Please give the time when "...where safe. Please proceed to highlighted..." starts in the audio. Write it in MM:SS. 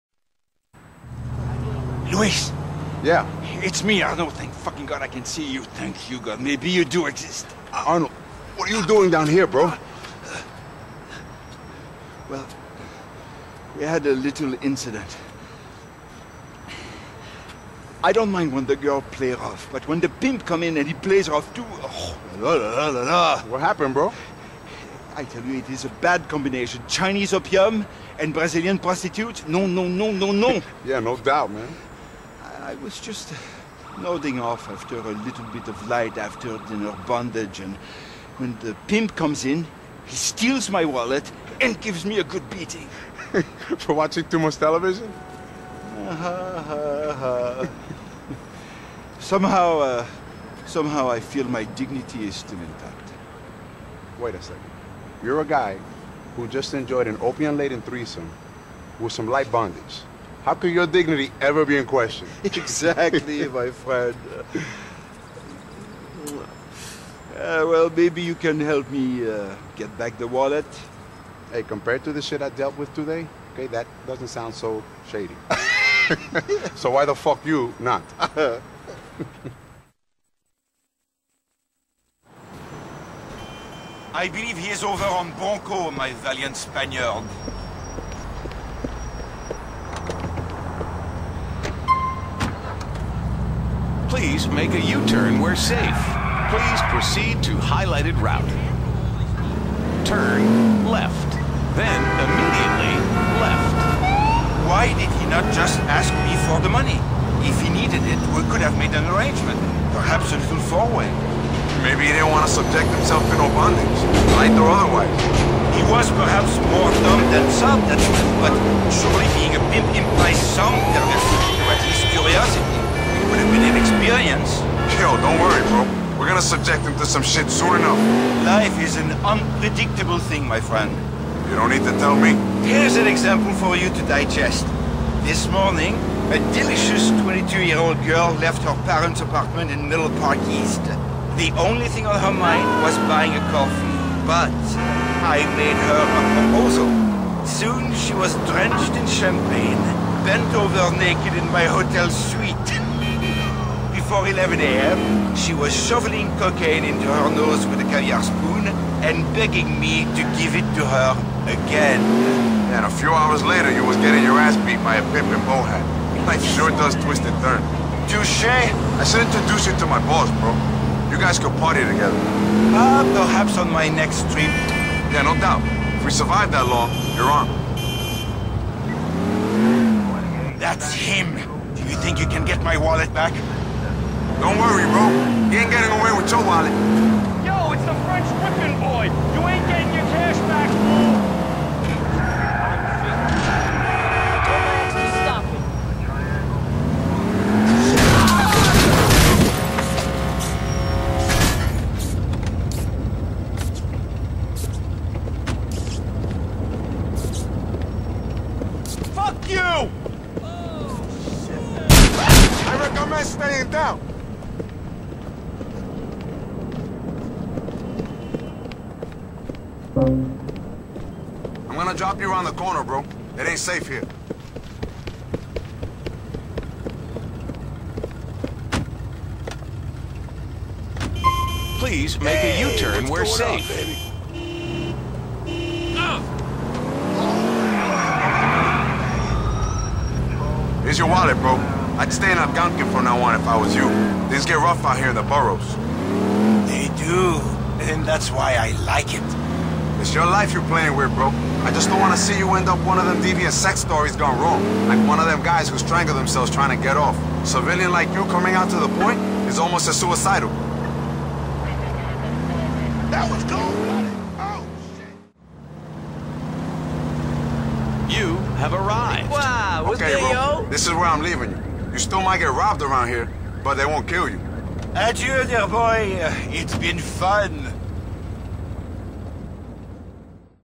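01:35.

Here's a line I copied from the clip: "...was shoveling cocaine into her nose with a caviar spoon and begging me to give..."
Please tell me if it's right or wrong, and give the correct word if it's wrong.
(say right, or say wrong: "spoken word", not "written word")
right.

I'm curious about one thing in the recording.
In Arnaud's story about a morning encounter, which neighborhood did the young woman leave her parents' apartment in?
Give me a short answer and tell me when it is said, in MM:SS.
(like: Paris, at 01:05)
Middle Park East, at 02:19.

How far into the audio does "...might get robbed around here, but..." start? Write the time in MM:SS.
04:32.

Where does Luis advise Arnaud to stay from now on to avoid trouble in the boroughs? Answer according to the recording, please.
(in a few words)
Algonquin.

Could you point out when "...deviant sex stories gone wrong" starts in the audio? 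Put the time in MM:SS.
04:13.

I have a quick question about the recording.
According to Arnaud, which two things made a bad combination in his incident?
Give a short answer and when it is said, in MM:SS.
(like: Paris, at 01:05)
Chinese opium and Brazilian prostitutes, at 00:26.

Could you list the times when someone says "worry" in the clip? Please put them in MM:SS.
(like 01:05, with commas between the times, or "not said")
02:05, 03:04.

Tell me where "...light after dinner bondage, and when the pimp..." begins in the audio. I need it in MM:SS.
00:35.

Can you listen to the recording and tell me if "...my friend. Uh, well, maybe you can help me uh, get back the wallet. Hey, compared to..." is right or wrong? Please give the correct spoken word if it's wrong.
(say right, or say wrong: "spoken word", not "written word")
right.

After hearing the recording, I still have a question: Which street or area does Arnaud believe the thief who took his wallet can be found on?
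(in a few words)
Bronco.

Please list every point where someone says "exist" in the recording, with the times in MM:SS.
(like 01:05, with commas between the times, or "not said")
00:07.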